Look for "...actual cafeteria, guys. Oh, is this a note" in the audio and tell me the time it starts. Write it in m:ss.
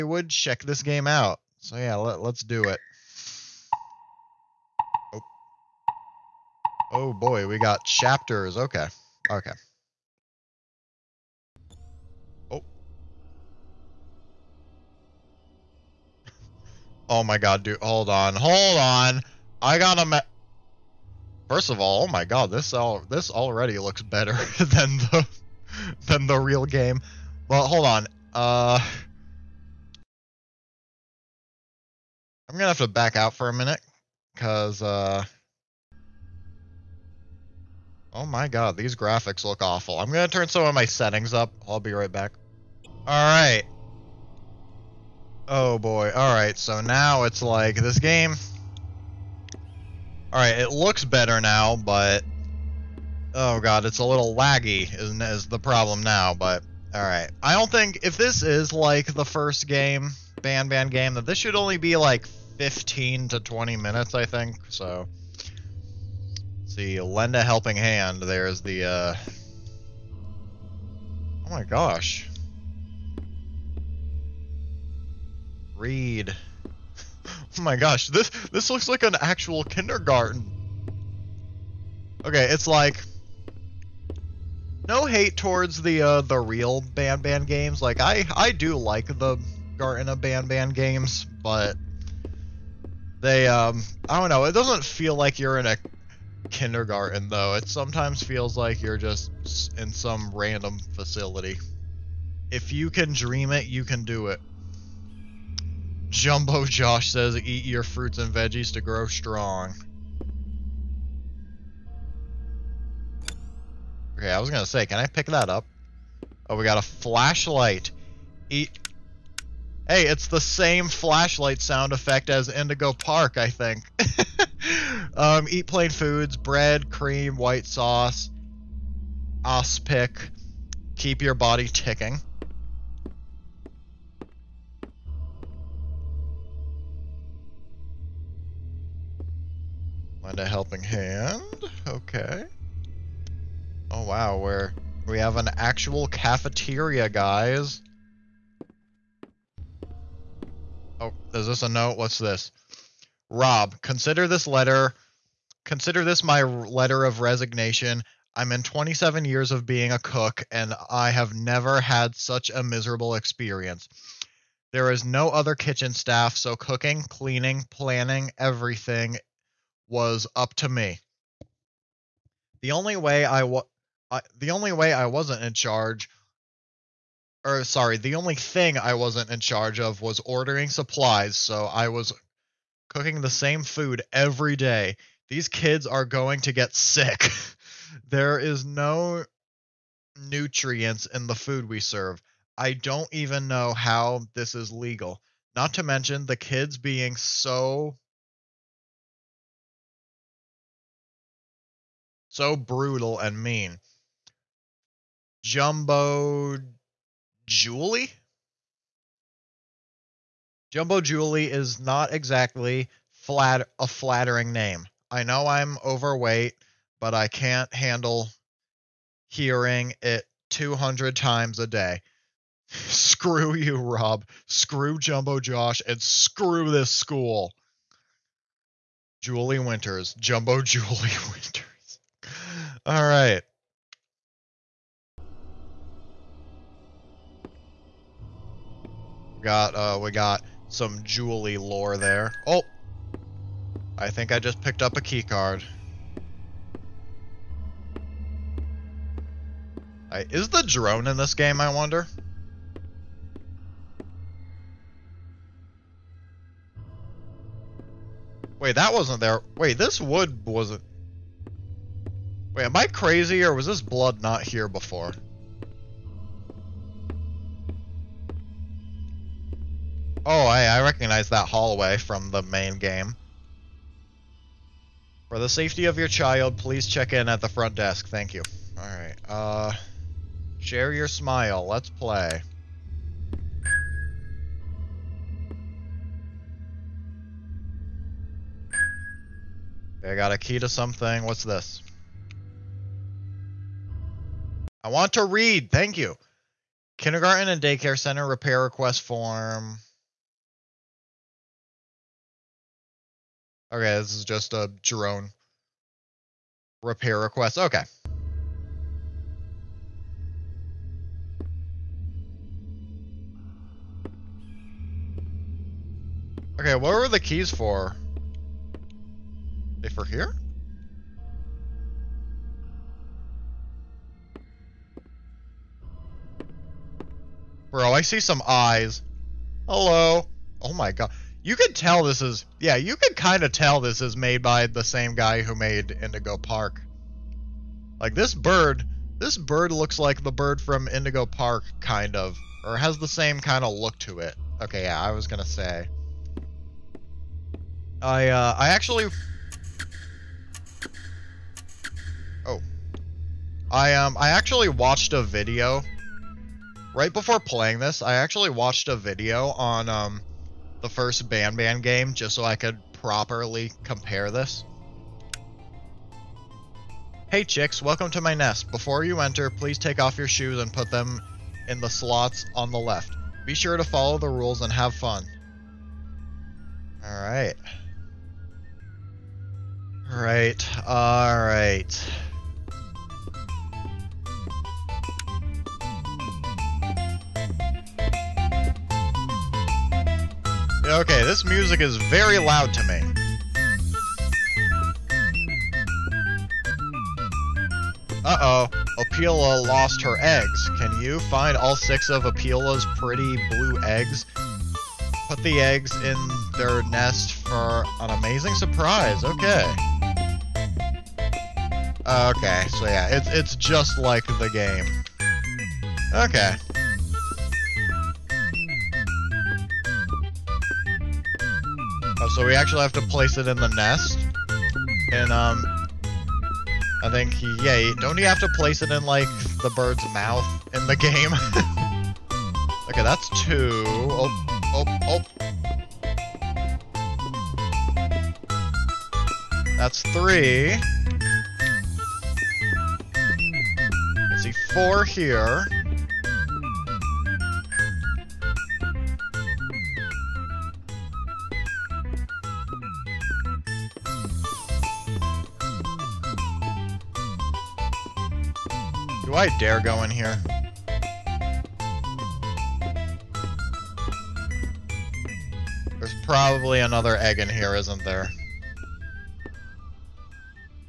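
2:25.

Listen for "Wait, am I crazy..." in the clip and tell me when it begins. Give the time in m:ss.
4:22.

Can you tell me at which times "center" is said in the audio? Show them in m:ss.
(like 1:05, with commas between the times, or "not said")
4:57.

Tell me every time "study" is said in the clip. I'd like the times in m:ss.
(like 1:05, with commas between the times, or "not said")
not said.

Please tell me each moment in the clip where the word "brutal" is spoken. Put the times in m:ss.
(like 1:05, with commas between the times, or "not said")
3:22.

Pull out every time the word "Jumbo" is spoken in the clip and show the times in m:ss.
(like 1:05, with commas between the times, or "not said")
1:46, 3:25, 3:30, 3:44, 3:50.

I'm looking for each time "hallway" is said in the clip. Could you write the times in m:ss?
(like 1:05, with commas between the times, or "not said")
4:31.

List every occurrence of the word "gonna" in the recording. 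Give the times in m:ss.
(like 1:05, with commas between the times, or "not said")
0:40, 1:54, 5:45.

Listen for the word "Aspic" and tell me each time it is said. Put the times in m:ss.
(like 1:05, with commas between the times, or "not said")
2:09.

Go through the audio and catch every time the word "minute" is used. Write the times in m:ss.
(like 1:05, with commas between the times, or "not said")
0:33, 1:03.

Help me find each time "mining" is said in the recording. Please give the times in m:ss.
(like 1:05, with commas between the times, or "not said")
not said.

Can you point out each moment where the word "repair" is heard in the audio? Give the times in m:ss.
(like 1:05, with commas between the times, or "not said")
4:58, 5:06.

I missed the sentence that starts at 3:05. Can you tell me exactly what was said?
These kids are going to get sick.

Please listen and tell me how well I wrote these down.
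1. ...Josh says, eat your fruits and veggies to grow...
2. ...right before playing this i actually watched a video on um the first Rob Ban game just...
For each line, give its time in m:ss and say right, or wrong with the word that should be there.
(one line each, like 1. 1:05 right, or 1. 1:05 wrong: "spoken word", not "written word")
1. 1:46 right
2. 5:56 wrong: "Ban", not "Rob".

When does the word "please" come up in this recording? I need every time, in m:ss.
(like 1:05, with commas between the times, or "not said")
4:36, 6:09.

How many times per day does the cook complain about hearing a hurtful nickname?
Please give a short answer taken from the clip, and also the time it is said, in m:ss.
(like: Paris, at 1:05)
200, at 3:40.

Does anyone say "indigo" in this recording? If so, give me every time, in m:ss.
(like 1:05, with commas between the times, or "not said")
2:02, 5:36, 5:40.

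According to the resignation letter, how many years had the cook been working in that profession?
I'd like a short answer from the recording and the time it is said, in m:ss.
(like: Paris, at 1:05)
27, at 2:38.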